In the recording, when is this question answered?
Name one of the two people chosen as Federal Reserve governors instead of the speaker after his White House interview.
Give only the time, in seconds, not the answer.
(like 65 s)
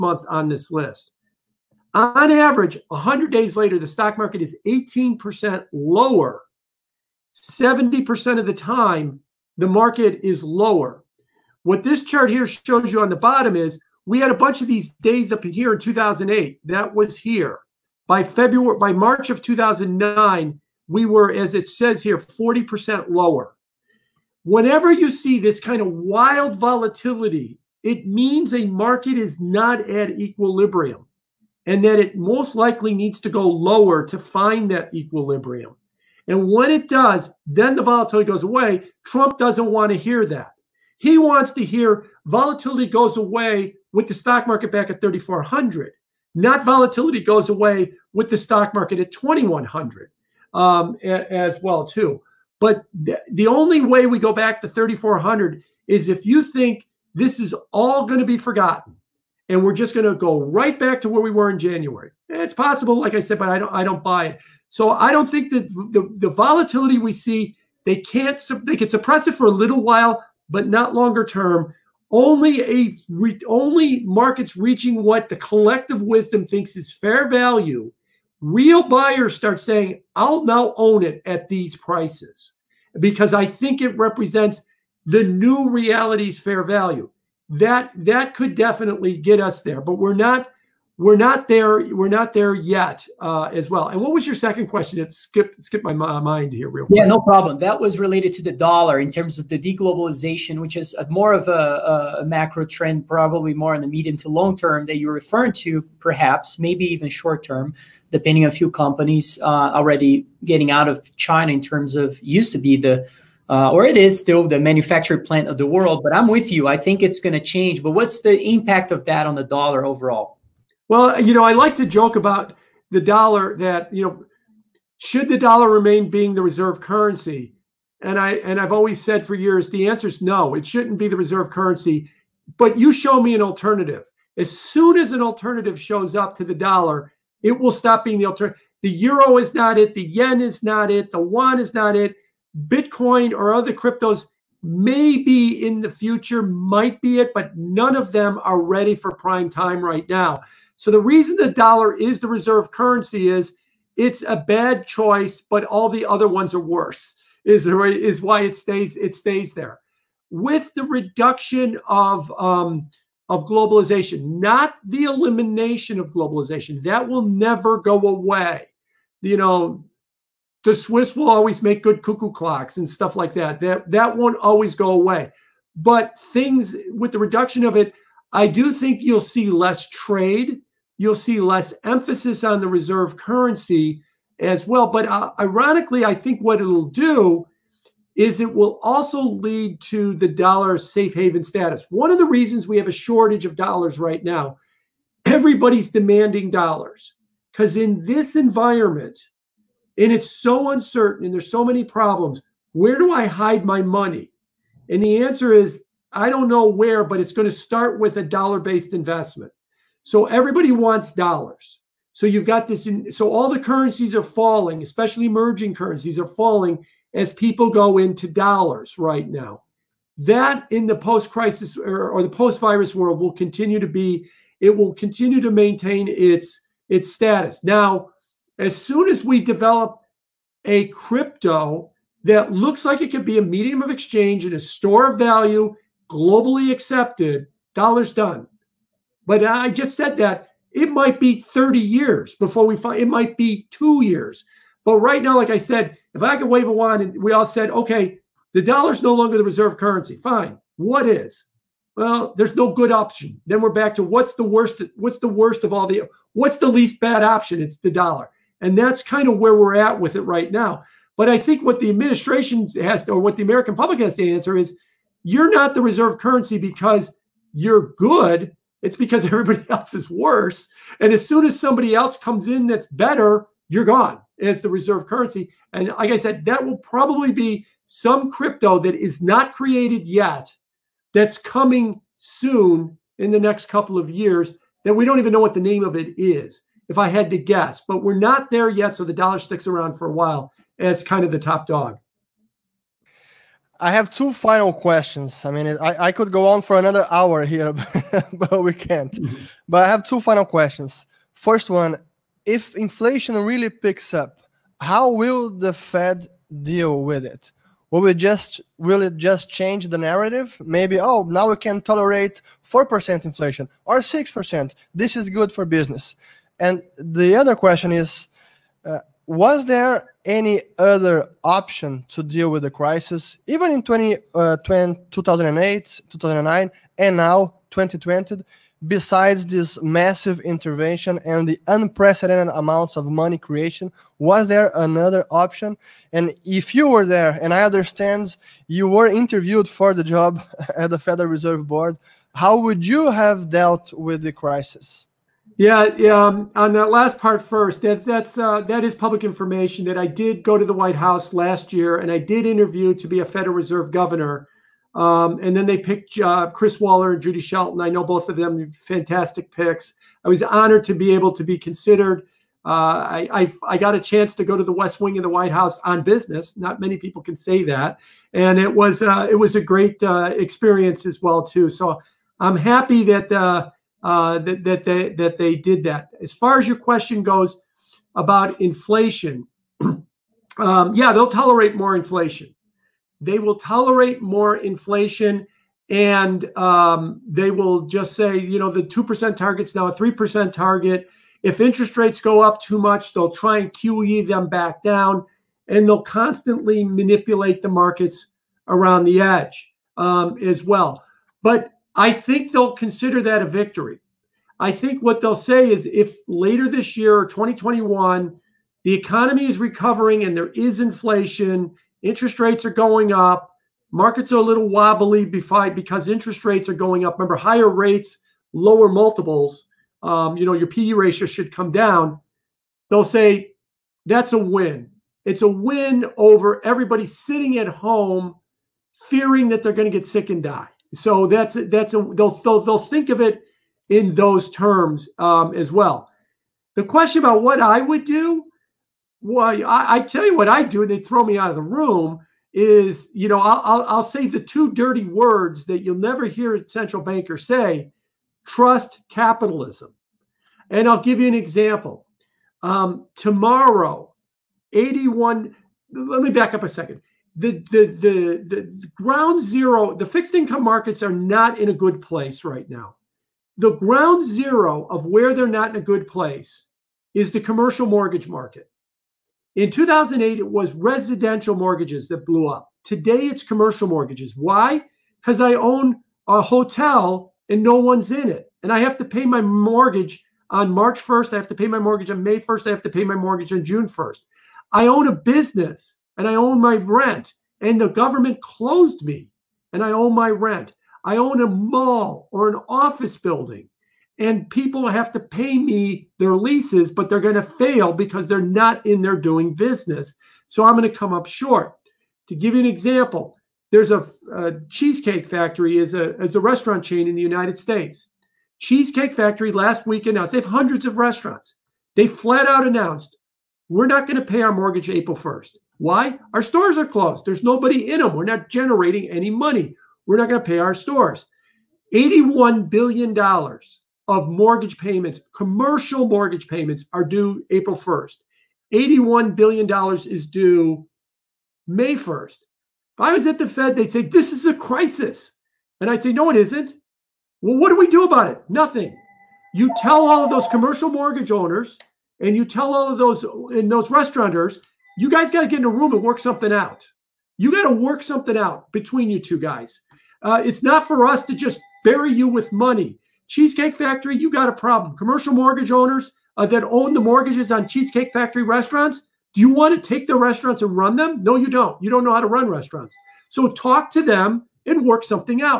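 356 s.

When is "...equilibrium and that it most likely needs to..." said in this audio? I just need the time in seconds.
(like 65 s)
30 s.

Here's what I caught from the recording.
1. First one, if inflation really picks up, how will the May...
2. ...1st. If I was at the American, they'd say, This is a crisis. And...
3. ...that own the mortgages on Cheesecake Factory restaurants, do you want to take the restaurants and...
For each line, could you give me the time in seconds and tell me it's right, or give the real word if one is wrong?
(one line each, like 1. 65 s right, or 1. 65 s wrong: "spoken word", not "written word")
1. 301 s wrong: "Fed", not "May"
2. 531 s wrong: "Fed", not "American"
3. 556 s right.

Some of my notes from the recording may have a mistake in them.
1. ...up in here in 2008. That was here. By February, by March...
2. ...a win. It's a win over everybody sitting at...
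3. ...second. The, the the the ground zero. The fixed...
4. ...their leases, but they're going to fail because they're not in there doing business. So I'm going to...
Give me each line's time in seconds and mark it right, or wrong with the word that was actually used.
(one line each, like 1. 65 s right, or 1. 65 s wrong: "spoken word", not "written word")
1. 15 s right
2. 424 s right
3. 456 s right
4. 496 s right.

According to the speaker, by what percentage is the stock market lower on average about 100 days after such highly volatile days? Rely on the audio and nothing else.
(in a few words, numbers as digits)
18%.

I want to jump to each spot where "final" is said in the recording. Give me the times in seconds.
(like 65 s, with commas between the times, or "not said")
294 s, 300 s.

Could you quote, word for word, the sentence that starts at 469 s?
In 2008, it was residential mortgages that blew up.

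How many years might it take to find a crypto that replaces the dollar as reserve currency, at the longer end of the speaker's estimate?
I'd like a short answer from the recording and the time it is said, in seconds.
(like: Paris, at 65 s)
30 years, at 241 s.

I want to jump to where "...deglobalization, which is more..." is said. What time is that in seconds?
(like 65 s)
99 s.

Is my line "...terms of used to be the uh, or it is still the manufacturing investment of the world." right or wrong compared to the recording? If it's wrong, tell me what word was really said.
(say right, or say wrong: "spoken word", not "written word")
wrong: "plant", not "investment".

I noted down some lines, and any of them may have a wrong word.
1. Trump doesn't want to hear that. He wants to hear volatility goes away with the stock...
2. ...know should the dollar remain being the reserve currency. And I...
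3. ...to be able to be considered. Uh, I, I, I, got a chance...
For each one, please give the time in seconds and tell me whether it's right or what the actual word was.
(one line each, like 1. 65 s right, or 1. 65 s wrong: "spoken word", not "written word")
1. 39 s right
2. 124 s right
3. 360 s right.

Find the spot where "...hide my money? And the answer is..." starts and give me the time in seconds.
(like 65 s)
203 s.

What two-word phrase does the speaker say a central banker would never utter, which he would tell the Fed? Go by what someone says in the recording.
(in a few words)
trust capitalism.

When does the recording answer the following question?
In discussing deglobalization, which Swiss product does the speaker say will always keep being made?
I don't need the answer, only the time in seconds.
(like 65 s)
172 s.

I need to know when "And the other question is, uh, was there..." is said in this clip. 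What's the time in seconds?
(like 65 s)
316 s.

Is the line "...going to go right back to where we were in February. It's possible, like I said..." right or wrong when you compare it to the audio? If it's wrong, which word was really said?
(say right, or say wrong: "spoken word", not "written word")
wrong: "January", not "February".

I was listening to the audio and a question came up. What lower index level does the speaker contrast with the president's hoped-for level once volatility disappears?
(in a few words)
2,100.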